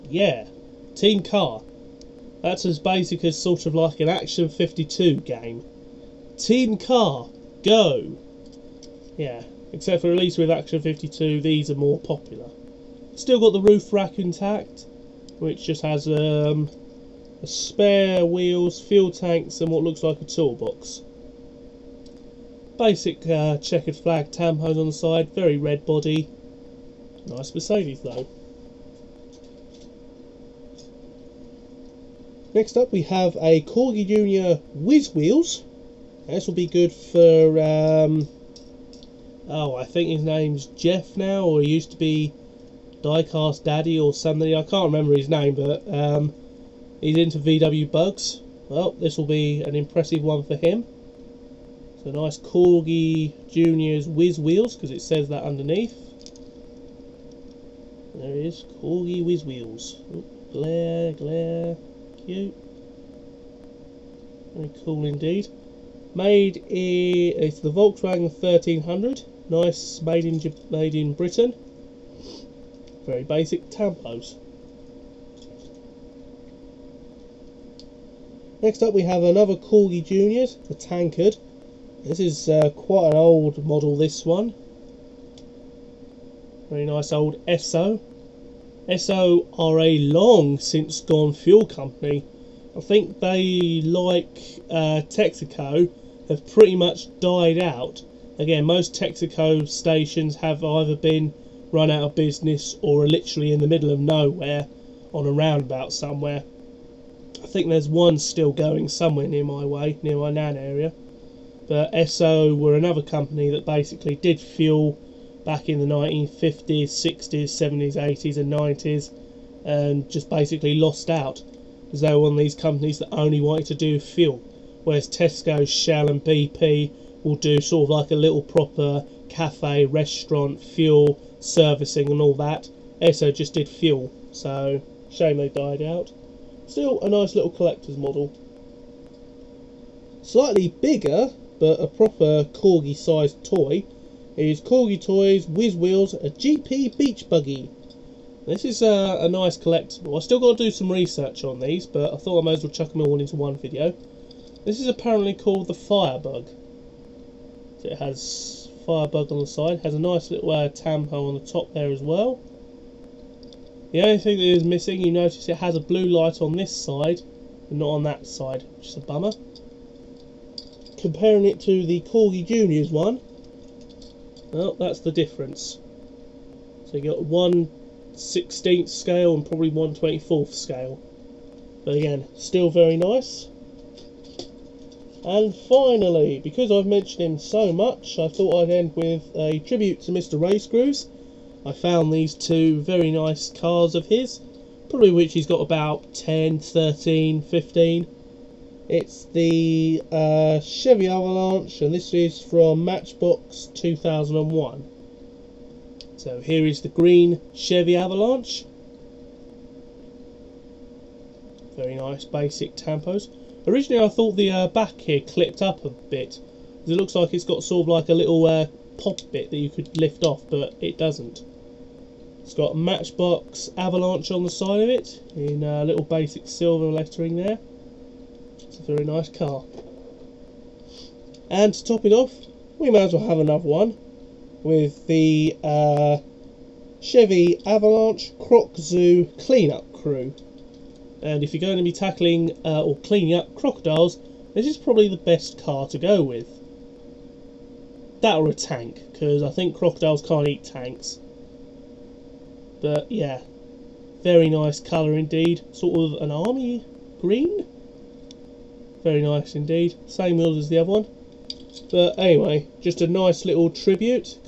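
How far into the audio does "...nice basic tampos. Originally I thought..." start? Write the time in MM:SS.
03:31.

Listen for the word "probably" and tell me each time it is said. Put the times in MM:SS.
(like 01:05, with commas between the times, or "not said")
02:59, 03:14, 04:04.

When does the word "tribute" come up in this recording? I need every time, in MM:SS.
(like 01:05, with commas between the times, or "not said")
03:09, 04:23.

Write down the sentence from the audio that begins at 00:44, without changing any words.
I can't remember his name but um, He's into VW Bugs.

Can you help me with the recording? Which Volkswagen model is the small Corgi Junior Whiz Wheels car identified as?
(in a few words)
Volkswagen 1300.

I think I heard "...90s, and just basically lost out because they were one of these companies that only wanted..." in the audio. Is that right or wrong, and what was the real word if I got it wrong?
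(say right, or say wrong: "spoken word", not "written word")
right.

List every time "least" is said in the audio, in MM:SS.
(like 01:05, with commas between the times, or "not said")
00:10.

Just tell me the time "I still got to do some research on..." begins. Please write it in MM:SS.
02:30.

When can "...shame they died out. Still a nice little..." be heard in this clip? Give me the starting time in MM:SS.
02:15.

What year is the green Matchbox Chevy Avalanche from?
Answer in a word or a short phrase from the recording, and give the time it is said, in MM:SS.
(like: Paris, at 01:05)
2001, at 03:23.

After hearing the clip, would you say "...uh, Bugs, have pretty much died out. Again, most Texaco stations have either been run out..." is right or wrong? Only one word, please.
wrong.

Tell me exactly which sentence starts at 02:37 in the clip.
So it has Firebug on the side, has a nice little uh, tampo on the top there as well.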